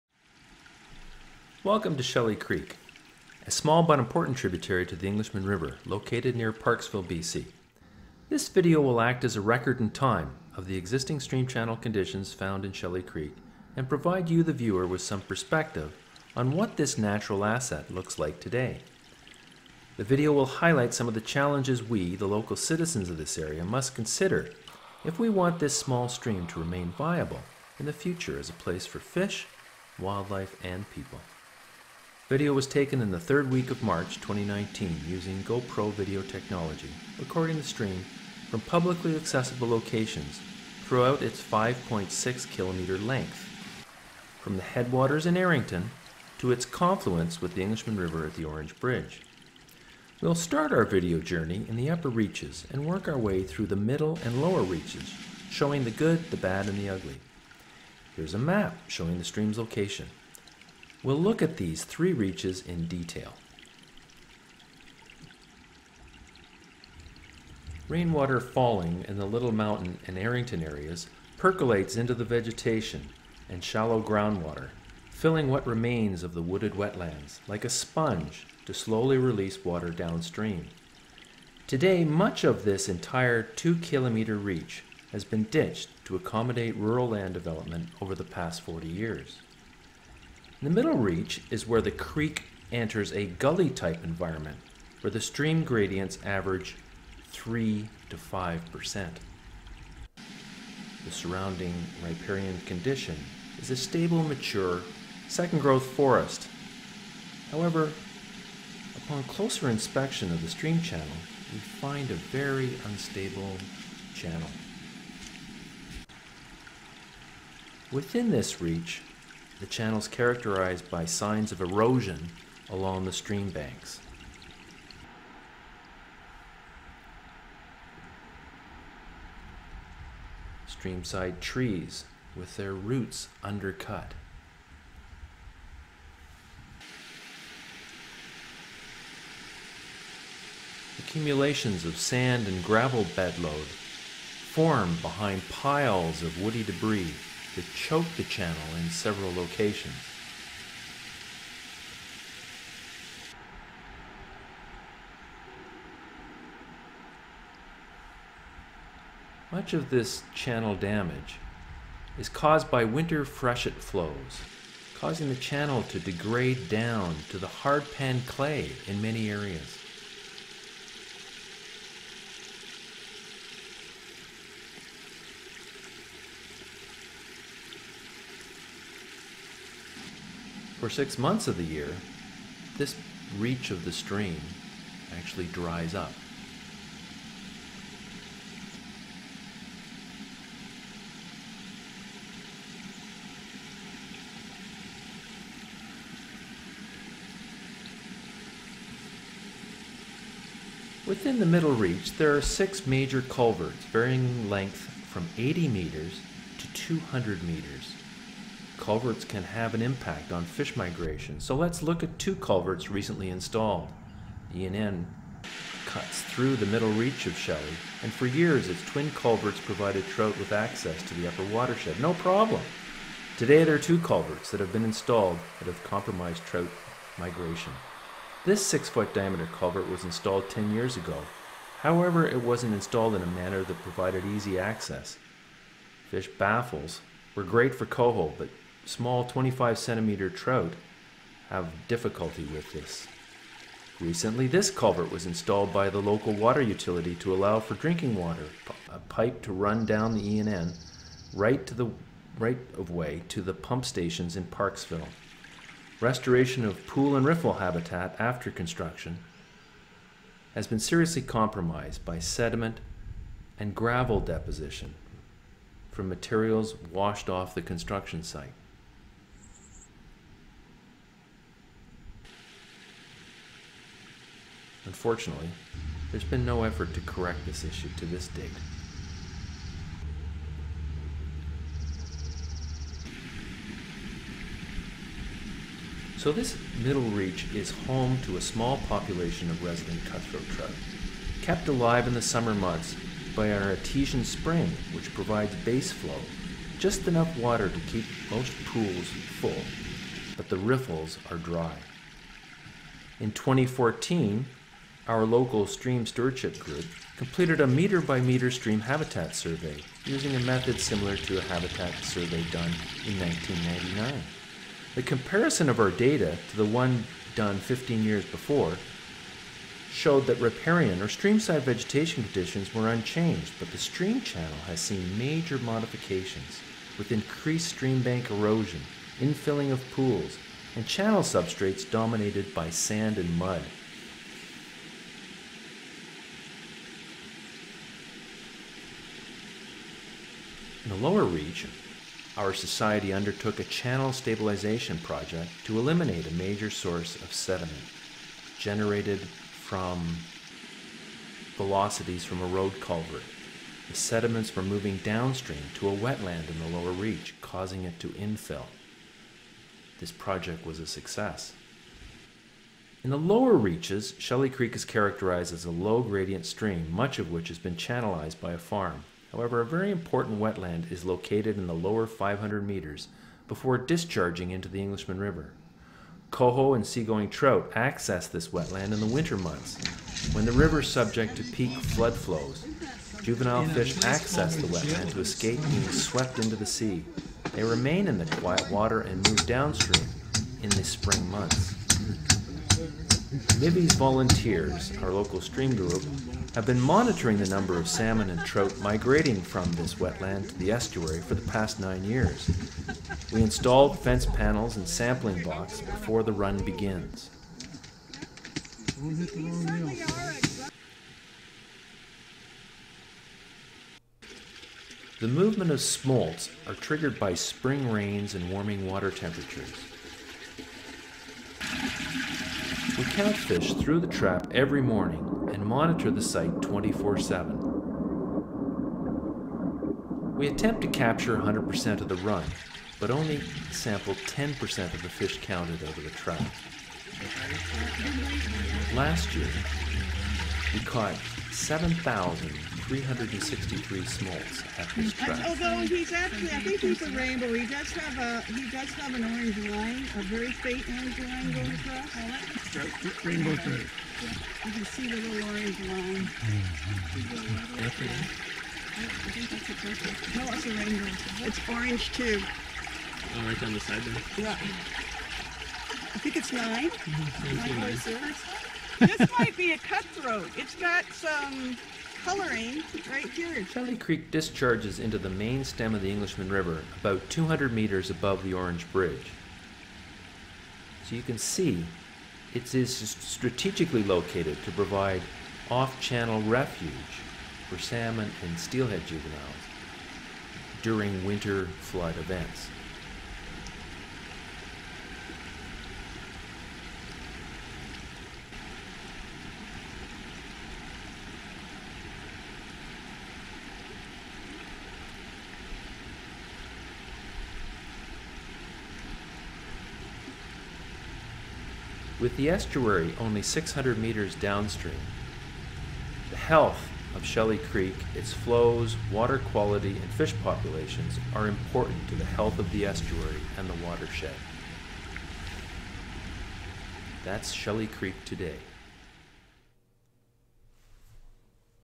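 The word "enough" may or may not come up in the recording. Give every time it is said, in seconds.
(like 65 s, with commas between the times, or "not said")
297 s.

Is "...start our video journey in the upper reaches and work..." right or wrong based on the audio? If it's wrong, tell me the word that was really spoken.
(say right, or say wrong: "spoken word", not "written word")
right.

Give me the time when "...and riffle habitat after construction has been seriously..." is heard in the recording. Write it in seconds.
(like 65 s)
257 s.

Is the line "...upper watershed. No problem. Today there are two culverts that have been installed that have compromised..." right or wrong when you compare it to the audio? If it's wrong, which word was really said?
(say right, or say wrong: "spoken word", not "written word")
right.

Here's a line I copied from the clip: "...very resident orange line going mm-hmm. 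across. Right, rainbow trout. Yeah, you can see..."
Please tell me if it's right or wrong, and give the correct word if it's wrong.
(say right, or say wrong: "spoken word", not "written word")
wrong: "faint", not "resident".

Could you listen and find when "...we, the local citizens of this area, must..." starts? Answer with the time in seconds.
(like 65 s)
21 s.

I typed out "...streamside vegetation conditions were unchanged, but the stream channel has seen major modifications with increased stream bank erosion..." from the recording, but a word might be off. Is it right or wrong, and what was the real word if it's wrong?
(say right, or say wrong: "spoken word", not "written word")
right.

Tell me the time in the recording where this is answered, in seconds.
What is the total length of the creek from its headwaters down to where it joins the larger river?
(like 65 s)
41 s.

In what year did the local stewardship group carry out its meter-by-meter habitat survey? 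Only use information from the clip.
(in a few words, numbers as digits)
2014.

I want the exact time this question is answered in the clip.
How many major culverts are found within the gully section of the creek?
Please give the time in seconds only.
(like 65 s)
202 s.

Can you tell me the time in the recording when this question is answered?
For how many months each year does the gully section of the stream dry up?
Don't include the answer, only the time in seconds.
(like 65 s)
180 s.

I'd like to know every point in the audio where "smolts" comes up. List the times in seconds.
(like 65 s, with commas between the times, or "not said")
415 s, 444 s.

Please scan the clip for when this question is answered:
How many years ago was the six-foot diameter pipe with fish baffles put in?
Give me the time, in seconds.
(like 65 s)
230 s.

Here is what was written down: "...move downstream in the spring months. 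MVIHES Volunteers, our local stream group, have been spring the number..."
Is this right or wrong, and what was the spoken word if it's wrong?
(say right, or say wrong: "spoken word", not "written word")
wrong: "monitoring", not "spring".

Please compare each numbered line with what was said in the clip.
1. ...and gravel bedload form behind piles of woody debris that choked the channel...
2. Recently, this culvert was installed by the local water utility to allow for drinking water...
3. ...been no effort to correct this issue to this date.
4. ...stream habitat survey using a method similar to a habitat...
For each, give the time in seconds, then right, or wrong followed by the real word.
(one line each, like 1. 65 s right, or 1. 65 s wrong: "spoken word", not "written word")
1. 142 s right
2. 243 s right
3. 276 s right
4. 308 s right.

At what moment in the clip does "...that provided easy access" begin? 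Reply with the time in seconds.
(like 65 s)
233 s.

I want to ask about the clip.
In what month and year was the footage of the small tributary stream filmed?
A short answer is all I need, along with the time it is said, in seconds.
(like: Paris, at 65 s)
March 2019, at 33 s.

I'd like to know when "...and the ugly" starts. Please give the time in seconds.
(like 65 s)
56 s.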